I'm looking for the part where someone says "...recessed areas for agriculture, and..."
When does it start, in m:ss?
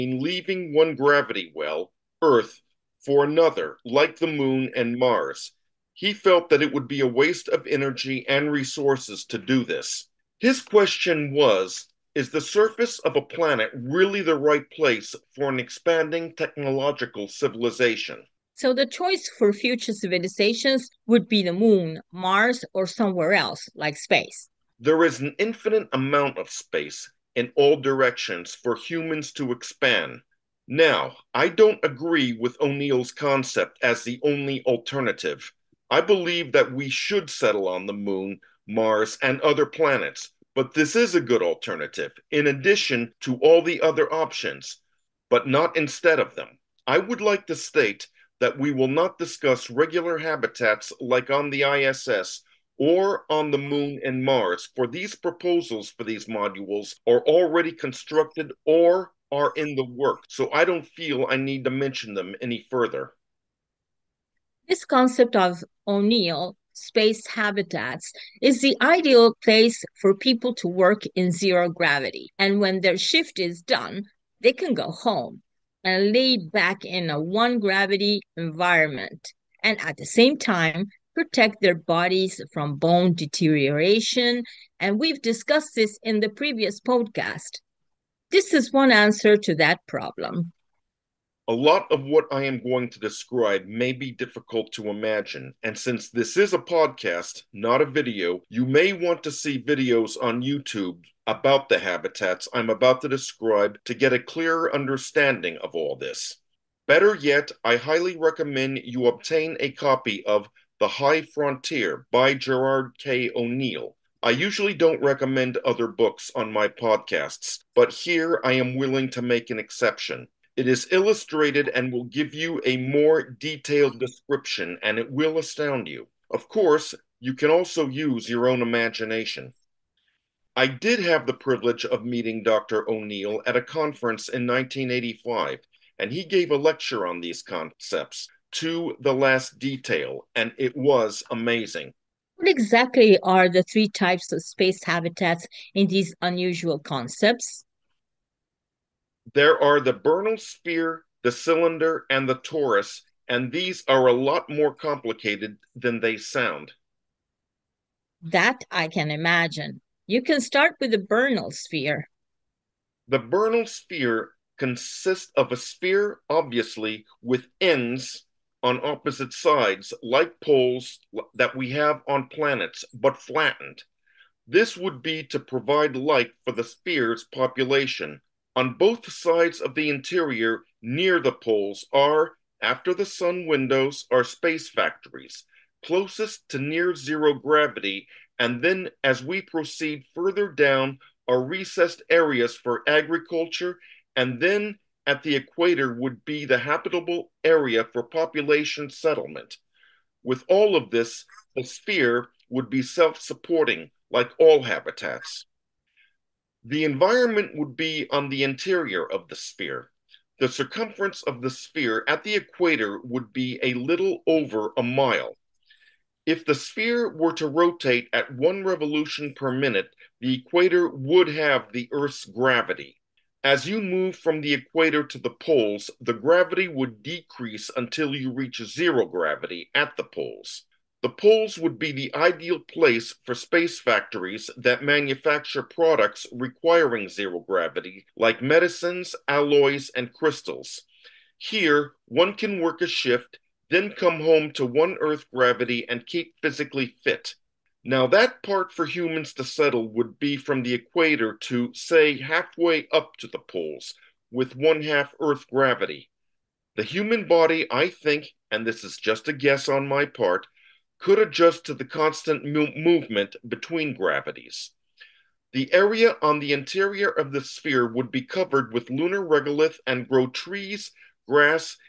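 3:11.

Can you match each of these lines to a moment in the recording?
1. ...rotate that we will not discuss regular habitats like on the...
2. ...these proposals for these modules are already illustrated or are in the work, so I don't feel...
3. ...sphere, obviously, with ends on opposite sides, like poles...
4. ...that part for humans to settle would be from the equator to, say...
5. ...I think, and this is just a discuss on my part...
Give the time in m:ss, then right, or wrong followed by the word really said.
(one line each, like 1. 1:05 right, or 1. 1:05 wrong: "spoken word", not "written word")
1. 0:47 wrong: "state", not "rotate"
2. 0:54 wrong: "constructed", not "illustrated"
3. 2:45 right
4. 4:08 right
5. 4:17 wrong: "guess", not "discuss".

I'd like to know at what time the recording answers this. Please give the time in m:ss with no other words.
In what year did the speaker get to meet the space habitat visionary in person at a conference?
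2:14.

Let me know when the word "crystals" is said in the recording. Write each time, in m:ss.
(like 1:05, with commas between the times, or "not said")
4:00.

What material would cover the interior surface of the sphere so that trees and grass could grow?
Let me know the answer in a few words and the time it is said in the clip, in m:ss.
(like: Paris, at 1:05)
Lunar regolith, at 4:28.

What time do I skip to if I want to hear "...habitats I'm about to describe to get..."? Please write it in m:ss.
1:41.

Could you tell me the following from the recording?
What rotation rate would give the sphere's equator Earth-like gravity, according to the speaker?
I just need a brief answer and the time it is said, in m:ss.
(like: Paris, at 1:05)
1 revolution per minute, at 3:38.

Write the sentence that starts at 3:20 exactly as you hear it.
With all of this, the sphere would be self supporting, like all habitats.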